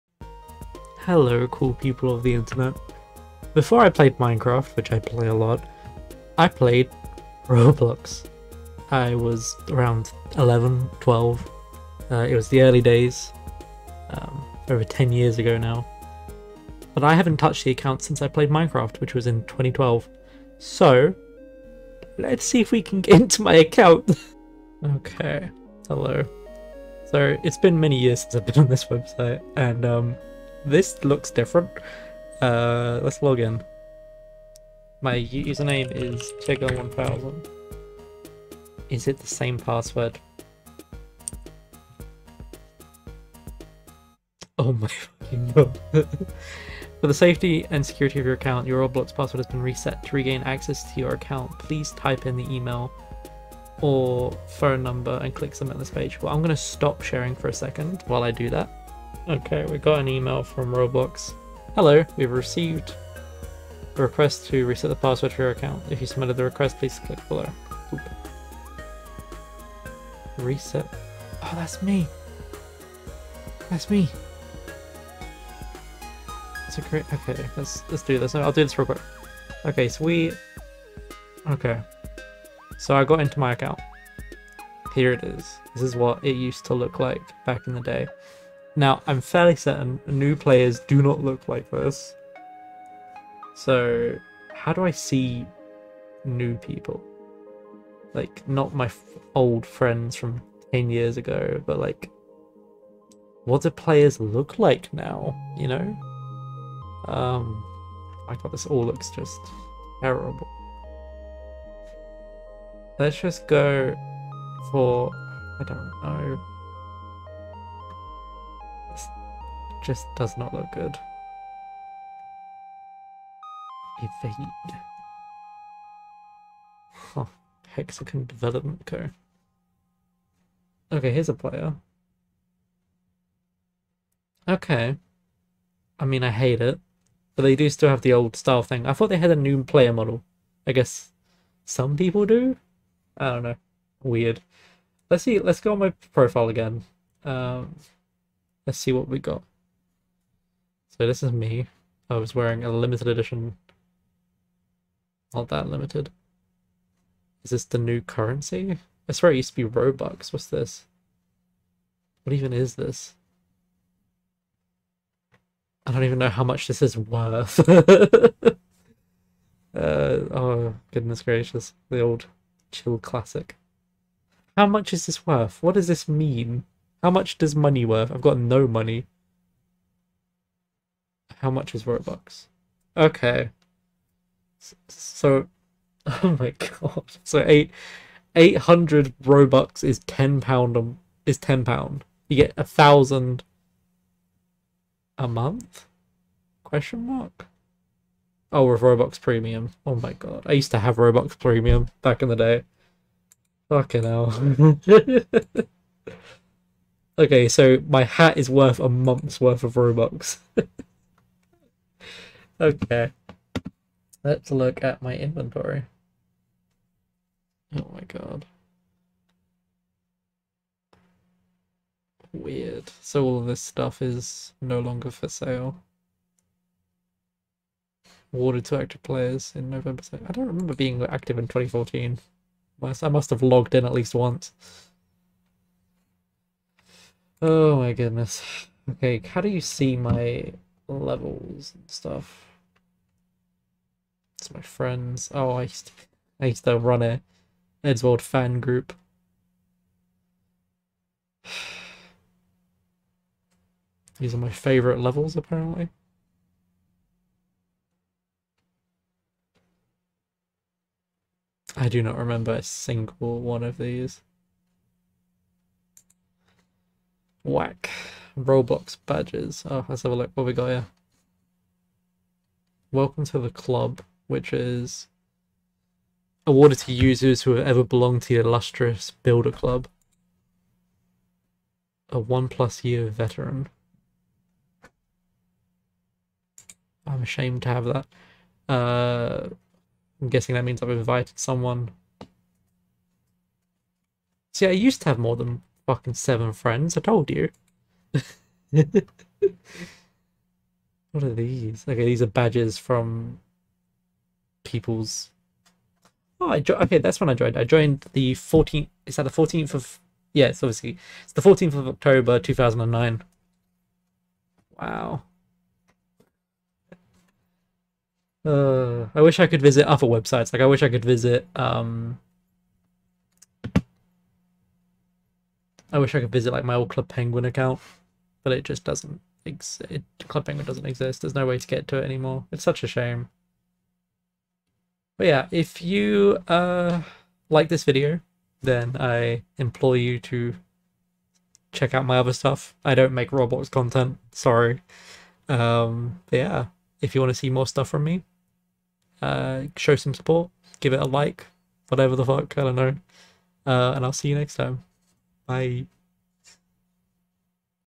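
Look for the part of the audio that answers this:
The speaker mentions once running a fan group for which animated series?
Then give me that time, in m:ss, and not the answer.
4:07.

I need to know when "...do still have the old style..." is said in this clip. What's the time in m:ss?
2:17.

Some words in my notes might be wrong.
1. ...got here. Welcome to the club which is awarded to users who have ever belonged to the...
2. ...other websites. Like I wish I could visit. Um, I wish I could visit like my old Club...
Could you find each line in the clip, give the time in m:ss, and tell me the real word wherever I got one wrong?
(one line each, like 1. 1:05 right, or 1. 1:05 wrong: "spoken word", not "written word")
1. 4:30 right
2. 5:19 right.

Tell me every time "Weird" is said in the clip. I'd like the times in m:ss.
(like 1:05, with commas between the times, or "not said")
2:24, 3:42.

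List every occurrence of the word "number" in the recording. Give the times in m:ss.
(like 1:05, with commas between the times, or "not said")
0:54.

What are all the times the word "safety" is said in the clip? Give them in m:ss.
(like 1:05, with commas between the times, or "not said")
0:47.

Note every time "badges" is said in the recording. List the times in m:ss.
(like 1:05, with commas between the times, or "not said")
4:29, 5:02.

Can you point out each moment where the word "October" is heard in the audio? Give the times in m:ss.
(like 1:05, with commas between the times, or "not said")
5:11.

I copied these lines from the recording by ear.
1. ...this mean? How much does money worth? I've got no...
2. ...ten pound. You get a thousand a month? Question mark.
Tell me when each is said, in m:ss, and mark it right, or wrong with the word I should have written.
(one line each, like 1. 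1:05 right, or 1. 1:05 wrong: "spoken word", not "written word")
1. 2:55 right
2. 3:11 right.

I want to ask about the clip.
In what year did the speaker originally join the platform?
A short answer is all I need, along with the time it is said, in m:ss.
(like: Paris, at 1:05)
2009, at 5:12.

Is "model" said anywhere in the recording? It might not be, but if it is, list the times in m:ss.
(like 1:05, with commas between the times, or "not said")
2:19.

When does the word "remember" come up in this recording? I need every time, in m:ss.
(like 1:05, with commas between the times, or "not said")
3:50, 4:22.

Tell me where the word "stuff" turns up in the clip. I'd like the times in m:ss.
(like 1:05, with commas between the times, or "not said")
3:43, 4:01, 5:42, 5:47.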